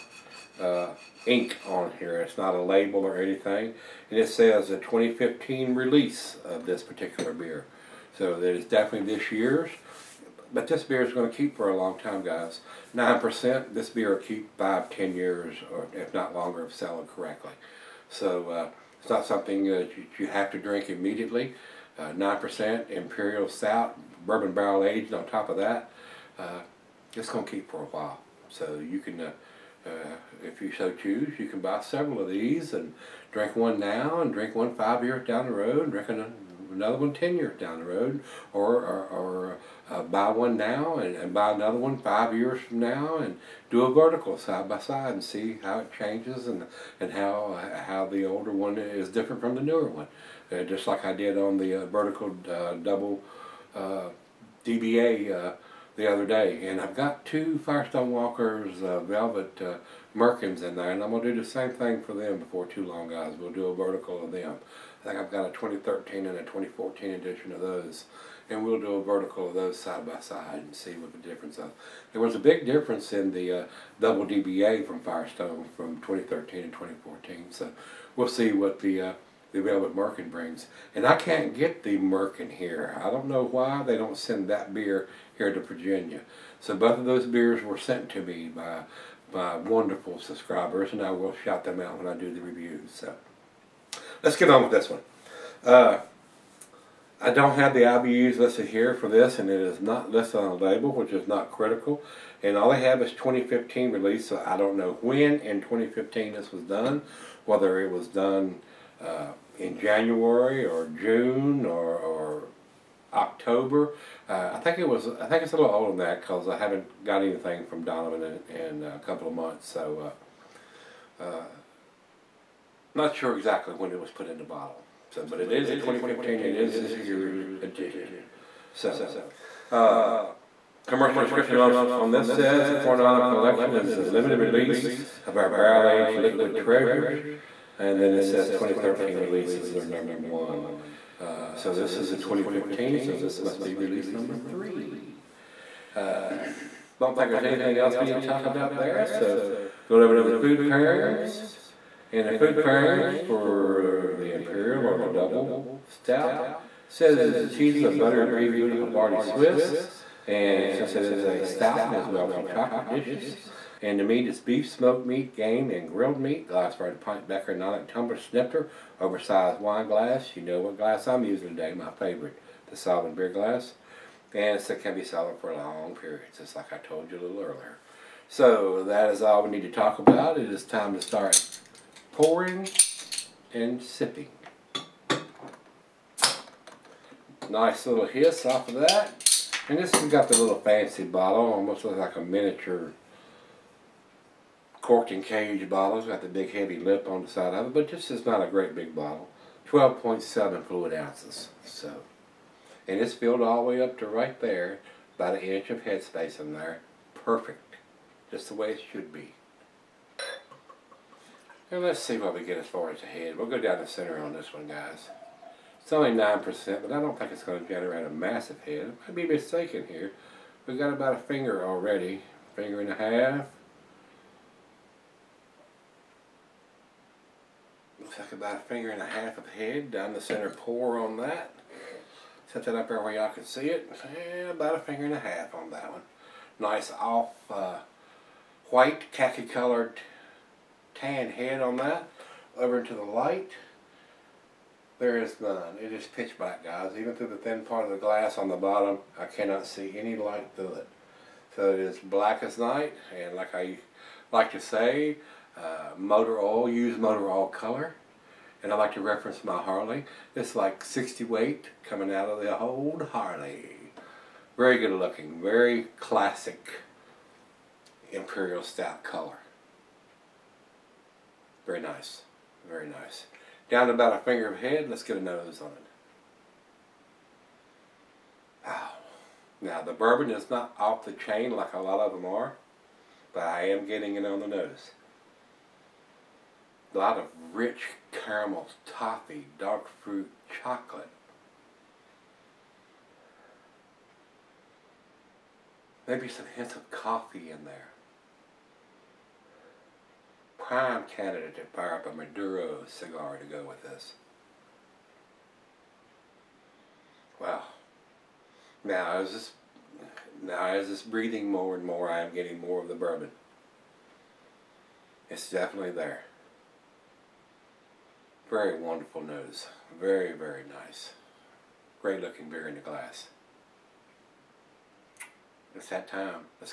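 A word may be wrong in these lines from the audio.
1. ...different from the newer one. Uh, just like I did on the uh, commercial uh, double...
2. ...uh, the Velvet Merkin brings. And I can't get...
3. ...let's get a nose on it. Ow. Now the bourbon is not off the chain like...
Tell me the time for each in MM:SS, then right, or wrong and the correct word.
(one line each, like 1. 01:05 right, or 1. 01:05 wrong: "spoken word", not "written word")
1. 00:49 wrong: "vertical", not "commercial"
2. 01:18 right
3. 04:34 right.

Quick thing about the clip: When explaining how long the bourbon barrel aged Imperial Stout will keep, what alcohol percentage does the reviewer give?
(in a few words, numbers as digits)
9%.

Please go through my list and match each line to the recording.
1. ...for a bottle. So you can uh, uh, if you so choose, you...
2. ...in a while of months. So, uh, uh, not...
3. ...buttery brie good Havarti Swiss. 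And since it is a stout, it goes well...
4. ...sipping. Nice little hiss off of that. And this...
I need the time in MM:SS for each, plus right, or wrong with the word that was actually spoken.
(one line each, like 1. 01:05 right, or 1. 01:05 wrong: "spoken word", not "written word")
1. 00:27 wrong: "while", not "bottle"
2. 01:58 wrong: "couple", not "while"
3. 02:37 right
4. 03:03 right.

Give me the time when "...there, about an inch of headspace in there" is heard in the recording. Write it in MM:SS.
03:24.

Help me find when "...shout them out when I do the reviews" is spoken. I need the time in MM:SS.
01:31.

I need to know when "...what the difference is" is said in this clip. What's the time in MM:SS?
01:10.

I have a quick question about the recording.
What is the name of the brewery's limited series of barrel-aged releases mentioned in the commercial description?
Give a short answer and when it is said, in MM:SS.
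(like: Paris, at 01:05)
Coronado Collection, at 02:12.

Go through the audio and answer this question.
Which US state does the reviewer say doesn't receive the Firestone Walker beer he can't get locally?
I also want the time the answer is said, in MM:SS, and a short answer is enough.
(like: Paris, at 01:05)
Virginia, at 01:25.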